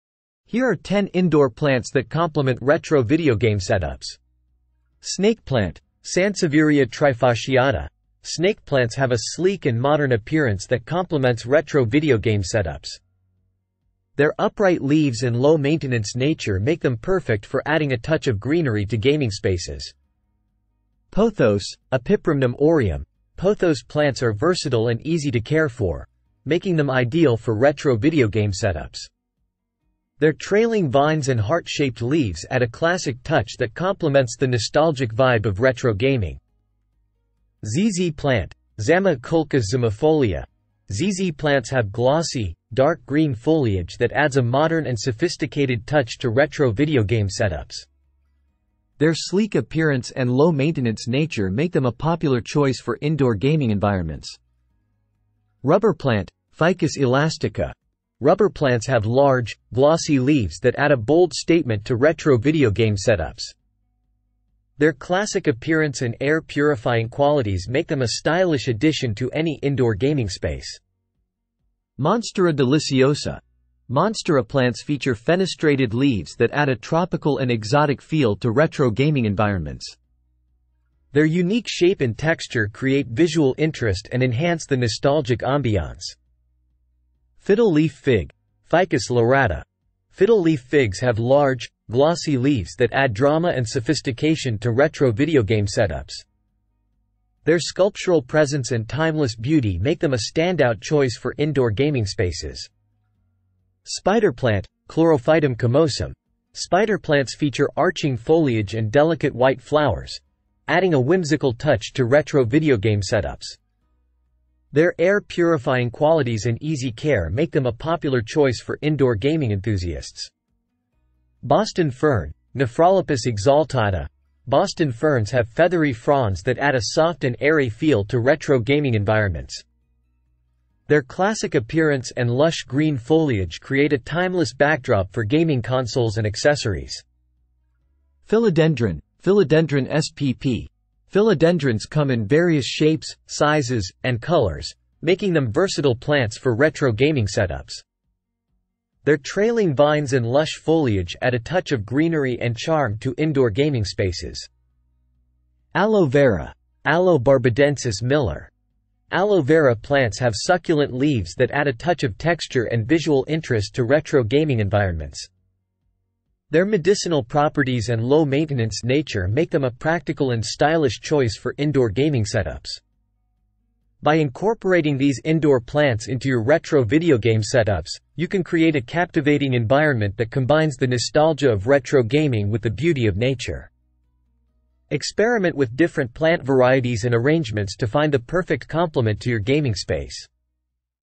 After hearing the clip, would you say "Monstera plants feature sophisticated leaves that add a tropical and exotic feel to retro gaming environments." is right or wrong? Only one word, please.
wrong.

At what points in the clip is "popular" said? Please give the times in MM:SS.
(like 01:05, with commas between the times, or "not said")
00:51, 01:57.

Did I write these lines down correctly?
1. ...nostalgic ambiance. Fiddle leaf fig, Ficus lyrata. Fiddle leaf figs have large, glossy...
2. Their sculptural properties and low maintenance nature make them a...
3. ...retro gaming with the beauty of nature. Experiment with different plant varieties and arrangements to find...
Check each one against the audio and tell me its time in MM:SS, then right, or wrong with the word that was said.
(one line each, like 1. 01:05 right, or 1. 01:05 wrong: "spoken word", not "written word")
1. 01:24 right
2. 02:46 wrong: "medicinal", not "sculptural"
3. 03:01 right.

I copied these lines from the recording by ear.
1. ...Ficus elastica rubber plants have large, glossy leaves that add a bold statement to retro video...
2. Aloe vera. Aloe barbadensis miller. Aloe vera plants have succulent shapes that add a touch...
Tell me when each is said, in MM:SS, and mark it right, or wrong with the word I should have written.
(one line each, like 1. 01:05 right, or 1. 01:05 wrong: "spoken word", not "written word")
1. 00:56 right
2. 02:35 wrong: "leaves", not "shapes".